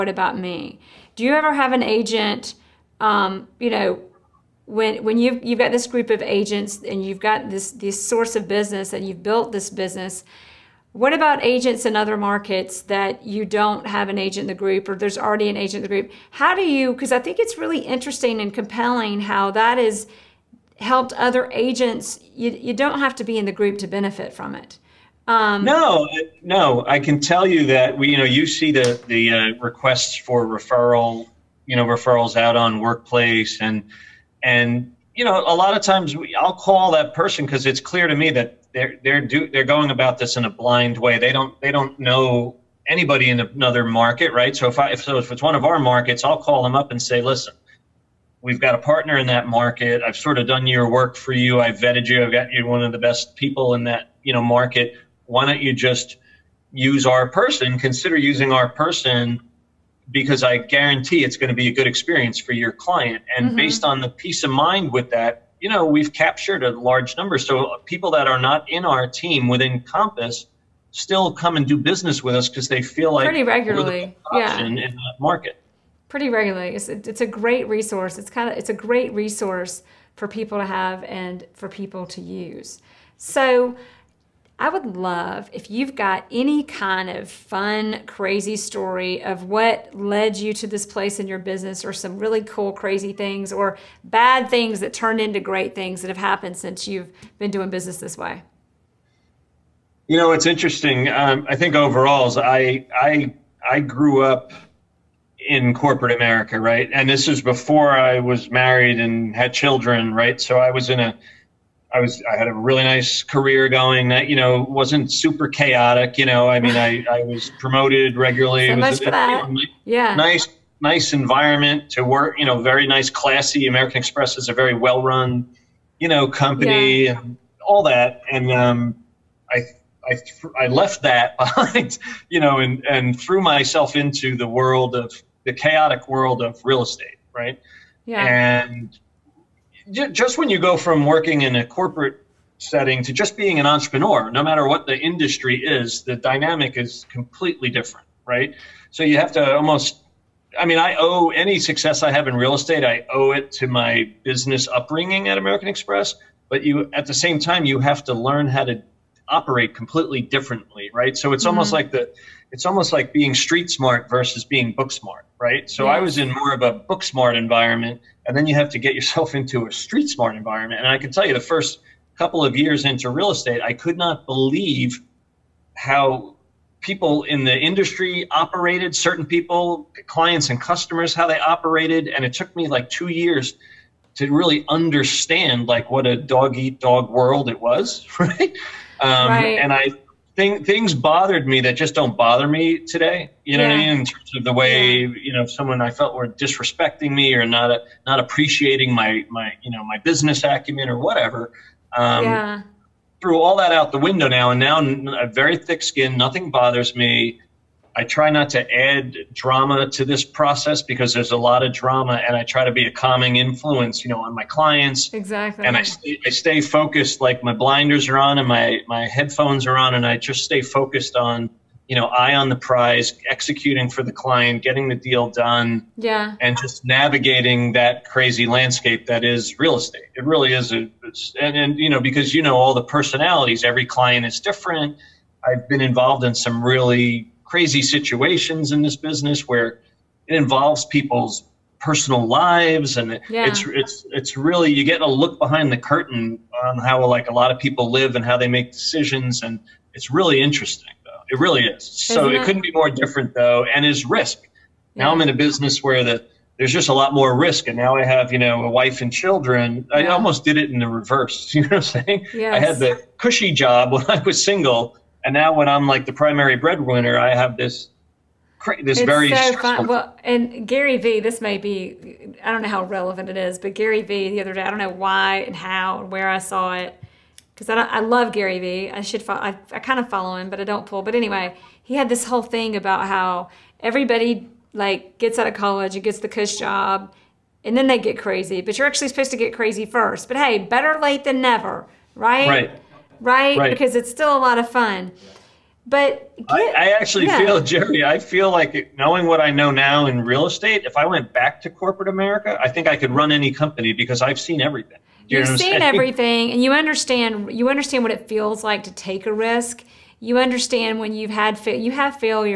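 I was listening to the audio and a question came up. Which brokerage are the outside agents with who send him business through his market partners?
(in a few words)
Compass.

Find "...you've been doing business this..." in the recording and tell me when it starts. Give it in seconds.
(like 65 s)
96 s.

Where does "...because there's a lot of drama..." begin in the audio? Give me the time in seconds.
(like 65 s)
210 s.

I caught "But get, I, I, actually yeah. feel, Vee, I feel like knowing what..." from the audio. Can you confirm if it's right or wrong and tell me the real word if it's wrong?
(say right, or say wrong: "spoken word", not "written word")
wrong: "Jere", not "Vee".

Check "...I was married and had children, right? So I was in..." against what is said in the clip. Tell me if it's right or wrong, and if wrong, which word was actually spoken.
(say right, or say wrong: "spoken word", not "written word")
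right.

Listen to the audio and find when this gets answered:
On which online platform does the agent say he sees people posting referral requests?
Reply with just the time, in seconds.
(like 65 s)
32 s.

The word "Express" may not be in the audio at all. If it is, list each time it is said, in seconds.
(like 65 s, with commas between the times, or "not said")
123 s, 155 s.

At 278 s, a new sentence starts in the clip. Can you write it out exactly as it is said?
I should follow, I, I kind of follow him, but I don't pull.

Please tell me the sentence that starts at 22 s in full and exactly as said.
You, you don't have to be in the group to benefit from it.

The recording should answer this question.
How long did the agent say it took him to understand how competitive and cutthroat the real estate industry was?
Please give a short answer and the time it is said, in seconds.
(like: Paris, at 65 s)
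2 years, at 182 s.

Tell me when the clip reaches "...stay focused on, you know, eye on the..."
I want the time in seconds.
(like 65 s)
220 s.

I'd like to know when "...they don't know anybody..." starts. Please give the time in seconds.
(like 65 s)
41 s.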